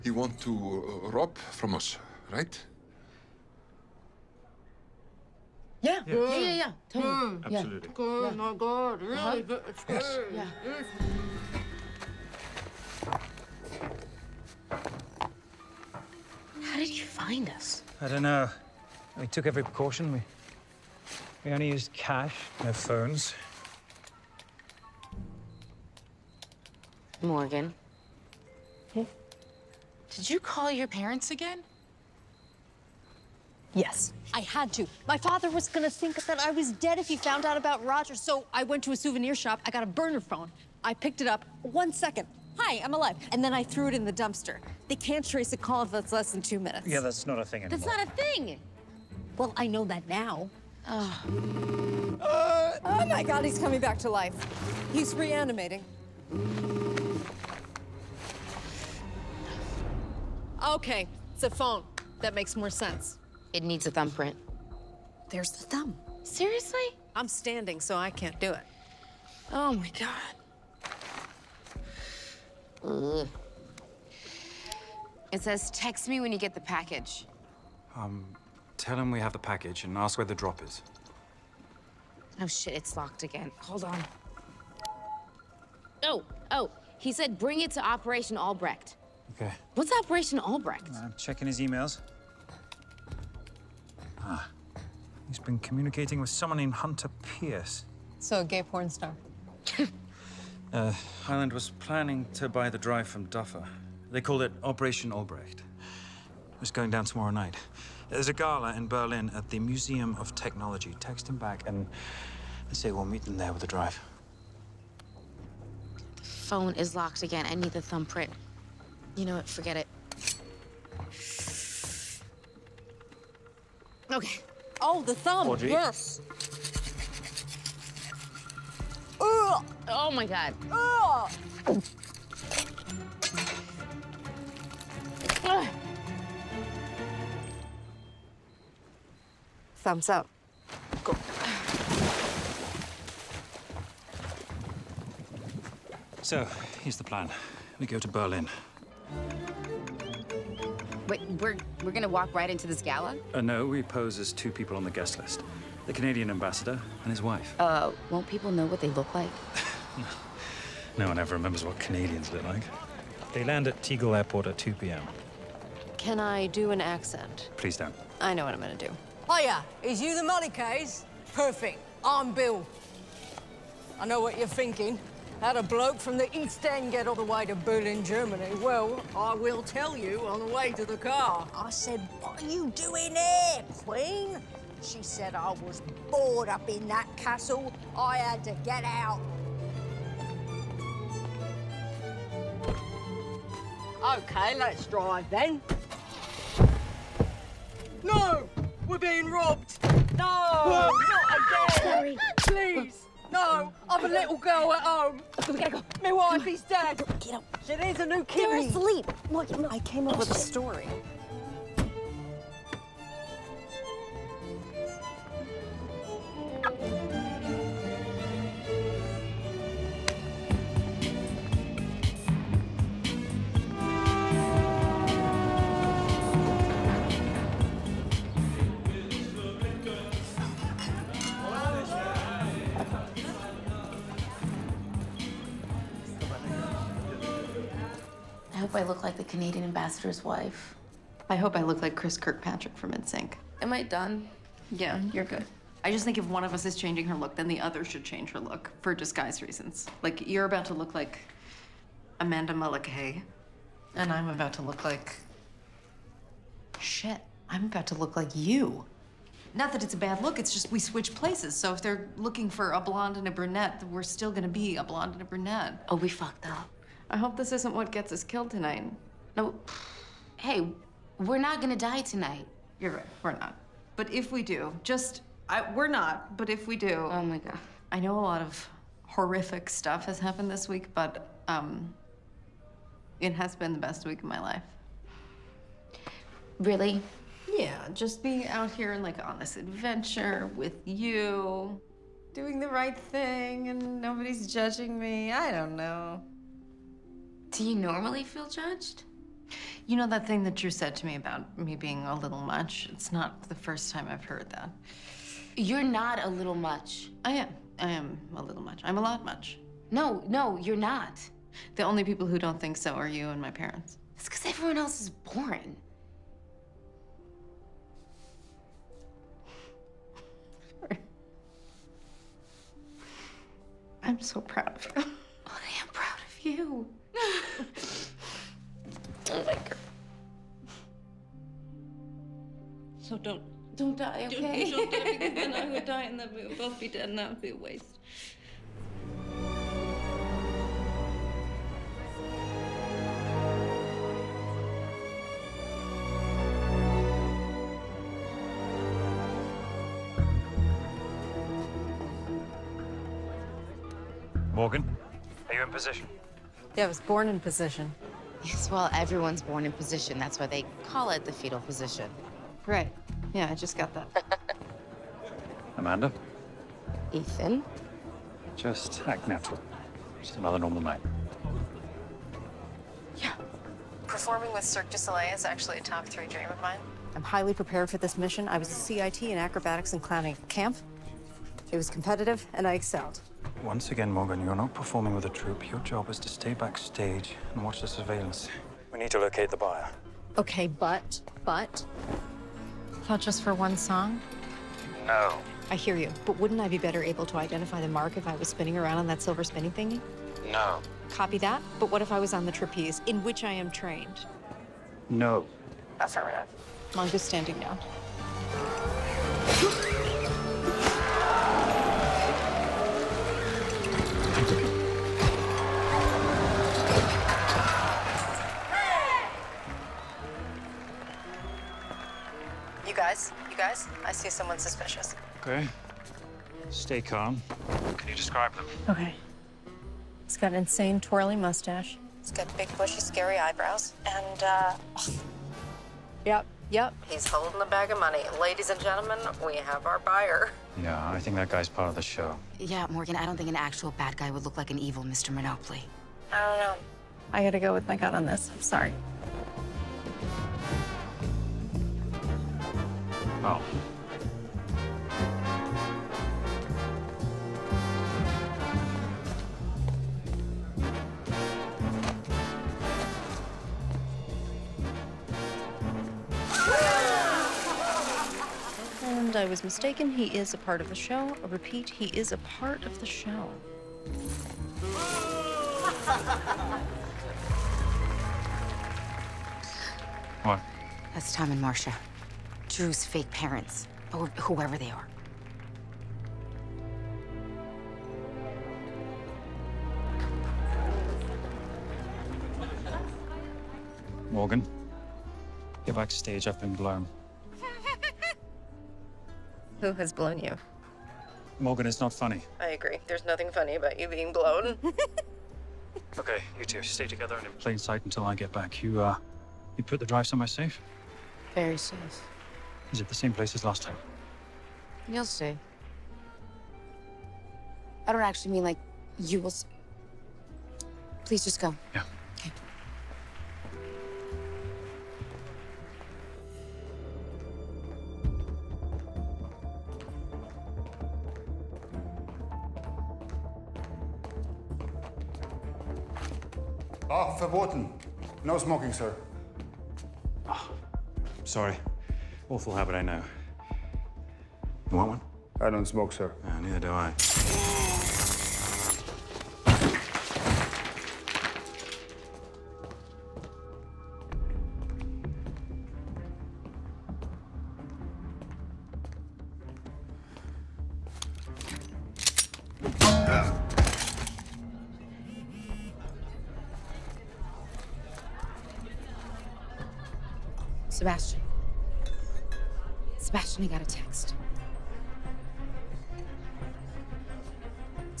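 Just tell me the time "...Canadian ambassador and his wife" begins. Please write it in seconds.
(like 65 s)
155 s.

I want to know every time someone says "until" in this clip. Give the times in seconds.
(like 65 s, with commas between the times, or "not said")
508 s.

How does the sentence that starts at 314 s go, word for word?
It's because everyone else is boring.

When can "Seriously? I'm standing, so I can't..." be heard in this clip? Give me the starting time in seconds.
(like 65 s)
66 s.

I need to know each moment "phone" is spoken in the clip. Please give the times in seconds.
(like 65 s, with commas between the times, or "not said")
22 s, 40 s, 61 s, 116 s.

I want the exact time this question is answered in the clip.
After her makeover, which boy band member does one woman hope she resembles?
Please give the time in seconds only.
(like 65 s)
241 s.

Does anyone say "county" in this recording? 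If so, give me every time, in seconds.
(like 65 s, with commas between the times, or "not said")
not said.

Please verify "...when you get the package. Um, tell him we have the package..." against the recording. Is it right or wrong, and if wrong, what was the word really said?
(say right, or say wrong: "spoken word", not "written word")
right.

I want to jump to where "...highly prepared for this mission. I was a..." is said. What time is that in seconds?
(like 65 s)
377 s.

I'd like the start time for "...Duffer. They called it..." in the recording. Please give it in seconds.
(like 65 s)
103 s.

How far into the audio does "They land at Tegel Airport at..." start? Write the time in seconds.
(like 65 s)
163 s.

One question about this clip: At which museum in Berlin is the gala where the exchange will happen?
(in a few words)
Museum of Technology.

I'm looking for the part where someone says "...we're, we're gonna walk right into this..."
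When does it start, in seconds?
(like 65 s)
151 s.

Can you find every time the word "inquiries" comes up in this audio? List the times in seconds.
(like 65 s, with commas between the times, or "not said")
not said.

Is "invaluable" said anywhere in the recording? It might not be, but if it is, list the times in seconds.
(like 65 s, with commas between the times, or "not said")
not said.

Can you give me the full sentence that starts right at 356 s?
Yeah, I was born in position.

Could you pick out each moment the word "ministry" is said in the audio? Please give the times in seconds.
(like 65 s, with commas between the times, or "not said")
not said.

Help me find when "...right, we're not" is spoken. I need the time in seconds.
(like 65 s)
272 s.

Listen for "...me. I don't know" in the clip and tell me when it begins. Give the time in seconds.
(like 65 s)
294 s.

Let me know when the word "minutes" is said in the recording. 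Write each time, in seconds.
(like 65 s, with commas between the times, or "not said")
46 s.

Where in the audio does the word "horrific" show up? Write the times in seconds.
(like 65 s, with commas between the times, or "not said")
279 s.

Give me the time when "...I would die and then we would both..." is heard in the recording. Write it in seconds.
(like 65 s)
335 s.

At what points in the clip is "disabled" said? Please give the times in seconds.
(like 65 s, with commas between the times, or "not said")
not said.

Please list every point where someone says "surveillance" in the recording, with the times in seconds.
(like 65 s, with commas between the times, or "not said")
387 s.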